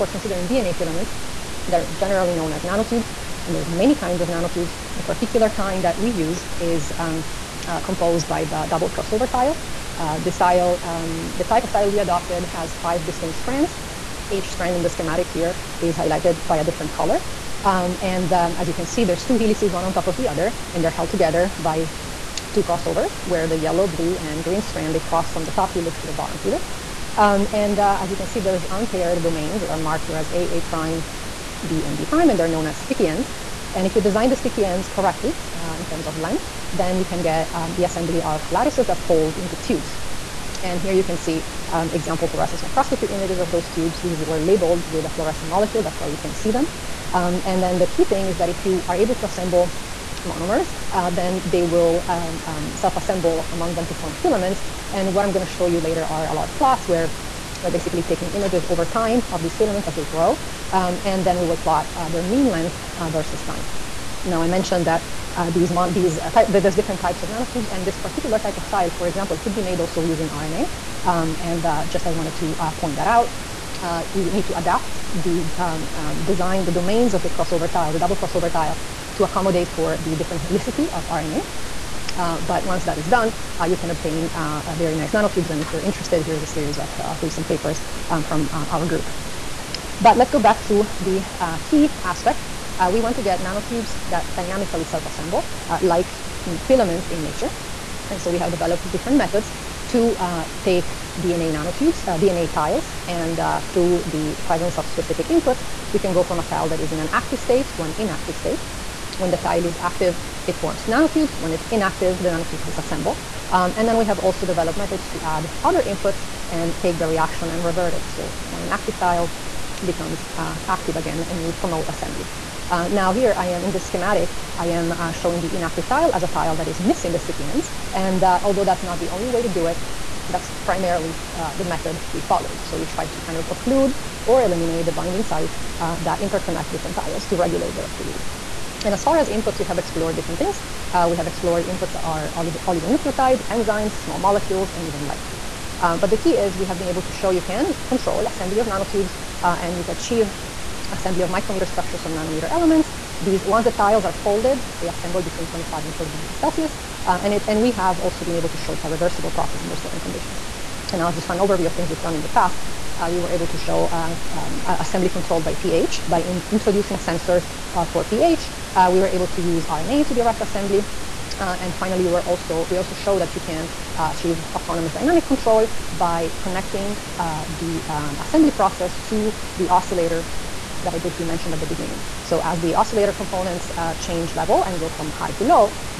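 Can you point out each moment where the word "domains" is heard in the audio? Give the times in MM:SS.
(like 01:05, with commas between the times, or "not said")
00:29, 01:16.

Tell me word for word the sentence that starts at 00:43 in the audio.
These were labeled with a fluorescent molecule.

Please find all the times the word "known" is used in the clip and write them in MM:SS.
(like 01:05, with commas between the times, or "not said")
00:02, 00:32.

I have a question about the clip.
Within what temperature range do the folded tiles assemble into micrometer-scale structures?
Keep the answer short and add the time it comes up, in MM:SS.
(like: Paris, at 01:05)
25 to 40 degrees Celsius, at 02:35.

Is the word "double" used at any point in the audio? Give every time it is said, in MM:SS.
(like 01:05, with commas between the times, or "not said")
00:08, 01:17.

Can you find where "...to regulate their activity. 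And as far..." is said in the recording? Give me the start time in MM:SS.
02:17.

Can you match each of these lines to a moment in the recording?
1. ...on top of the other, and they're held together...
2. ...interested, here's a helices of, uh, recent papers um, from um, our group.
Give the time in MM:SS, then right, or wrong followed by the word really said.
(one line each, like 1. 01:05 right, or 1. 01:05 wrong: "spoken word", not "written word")
1. 00:19 right
2. 01:25 wrong: "series", not "helices".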